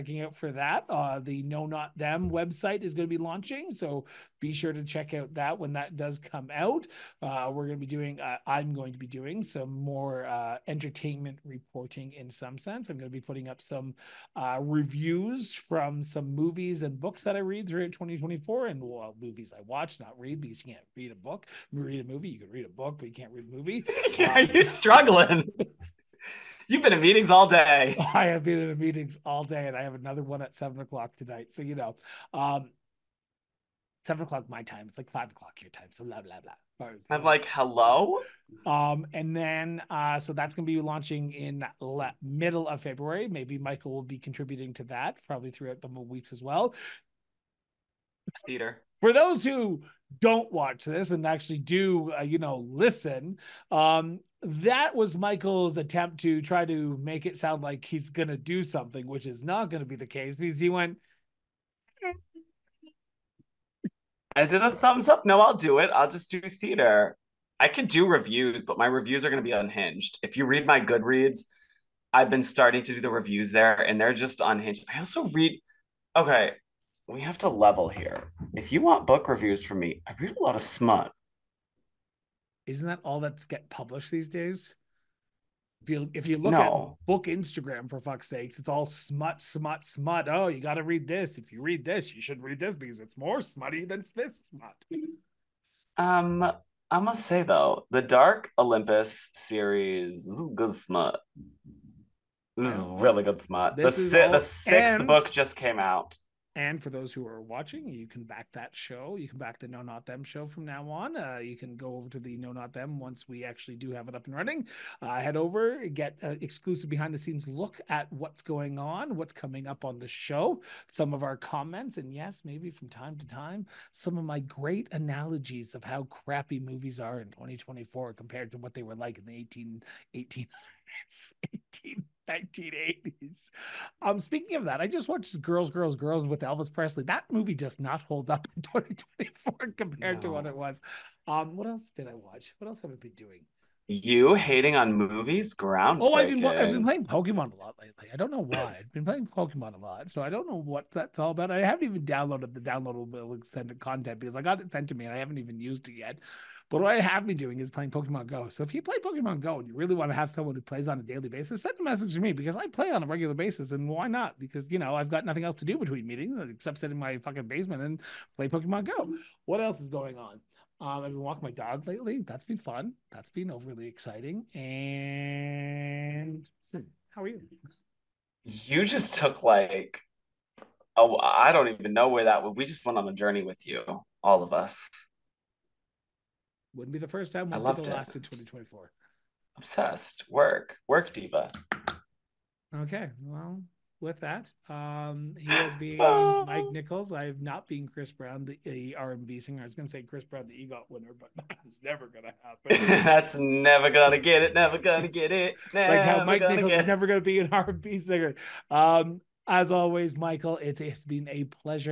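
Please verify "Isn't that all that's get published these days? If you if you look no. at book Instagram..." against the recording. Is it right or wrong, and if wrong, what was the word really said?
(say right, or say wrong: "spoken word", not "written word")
right.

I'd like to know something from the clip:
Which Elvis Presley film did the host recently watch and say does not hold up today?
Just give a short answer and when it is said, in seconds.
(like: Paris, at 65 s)
Girls, Girls, Girls, at 135 s.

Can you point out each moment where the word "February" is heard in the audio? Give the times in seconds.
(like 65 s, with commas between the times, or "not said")
42 s.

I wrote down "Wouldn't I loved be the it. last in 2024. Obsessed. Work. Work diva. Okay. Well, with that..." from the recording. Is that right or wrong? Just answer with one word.
right.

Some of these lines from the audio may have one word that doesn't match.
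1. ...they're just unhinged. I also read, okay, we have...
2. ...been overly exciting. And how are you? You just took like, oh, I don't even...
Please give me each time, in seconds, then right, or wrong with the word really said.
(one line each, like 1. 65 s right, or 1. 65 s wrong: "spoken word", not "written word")
1. 74 s right
2. 173 s right.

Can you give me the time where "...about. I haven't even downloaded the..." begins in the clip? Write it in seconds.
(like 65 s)
151 s.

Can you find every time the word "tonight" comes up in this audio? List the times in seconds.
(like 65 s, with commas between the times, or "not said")
31 s.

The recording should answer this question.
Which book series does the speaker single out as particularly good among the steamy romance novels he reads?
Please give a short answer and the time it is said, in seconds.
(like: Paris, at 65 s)
Dark Olympus, at 98 s.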